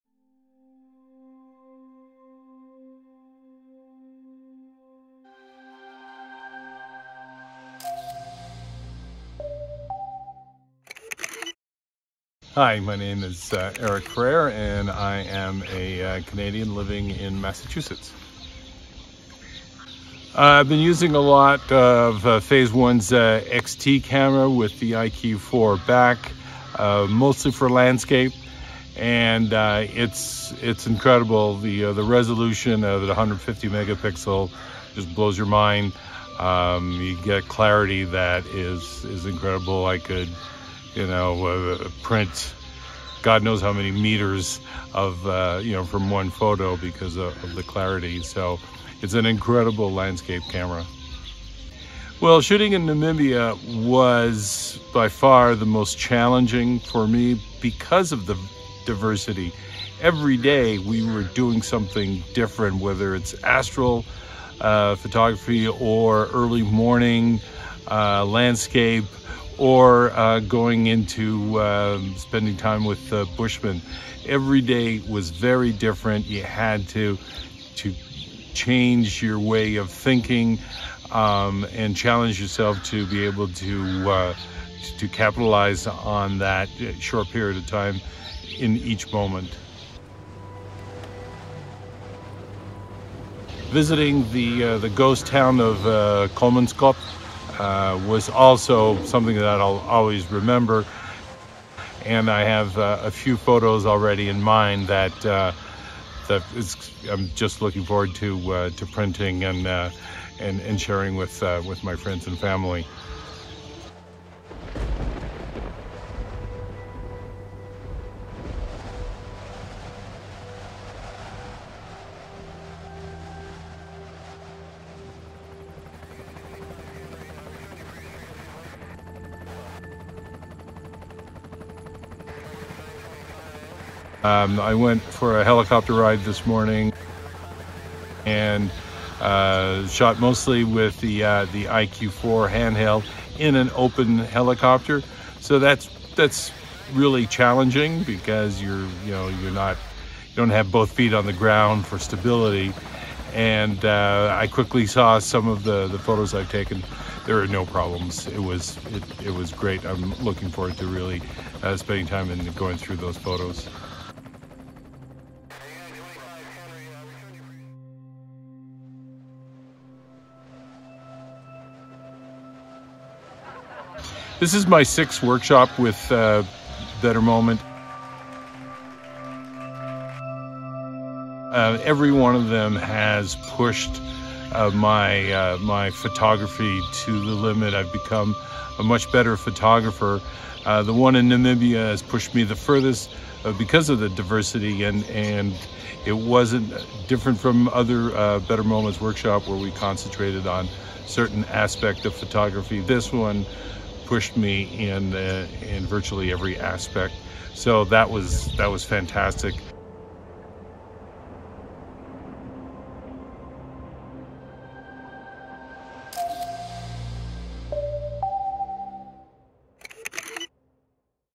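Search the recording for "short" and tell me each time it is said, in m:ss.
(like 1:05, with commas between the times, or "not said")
1:26.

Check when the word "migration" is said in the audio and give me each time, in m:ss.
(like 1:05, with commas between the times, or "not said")
not said.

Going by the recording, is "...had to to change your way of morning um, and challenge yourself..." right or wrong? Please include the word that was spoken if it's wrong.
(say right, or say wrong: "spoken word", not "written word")
wrong: "thinking", not "morning".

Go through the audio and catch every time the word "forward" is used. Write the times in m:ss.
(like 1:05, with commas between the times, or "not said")
1:47, 2:40.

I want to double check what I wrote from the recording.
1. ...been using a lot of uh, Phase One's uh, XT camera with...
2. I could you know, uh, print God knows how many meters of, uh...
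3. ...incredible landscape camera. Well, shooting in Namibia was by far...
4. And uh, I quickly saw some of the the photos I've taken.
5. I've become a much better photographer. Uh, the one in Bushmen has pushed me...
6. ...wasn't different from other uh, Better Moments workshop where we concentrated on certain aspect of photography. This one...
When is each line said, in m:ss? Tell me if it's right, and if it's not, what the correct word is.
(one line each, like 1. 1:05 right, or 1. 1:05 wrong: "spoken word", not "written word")
1. 0:20 right
2. 0:39 right
3. 0:49 right
4. 2:33 right
5. 3:07 wrong: "Namibia", not "Bushmen"
6. 3:16 right.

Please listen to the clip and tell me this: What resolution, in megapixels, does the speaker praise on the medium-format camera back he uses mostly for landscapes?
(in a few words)
150 megapixels.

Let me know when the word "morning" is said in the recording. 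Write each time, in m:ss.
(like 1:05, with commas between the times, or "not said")
1:06, 2:16.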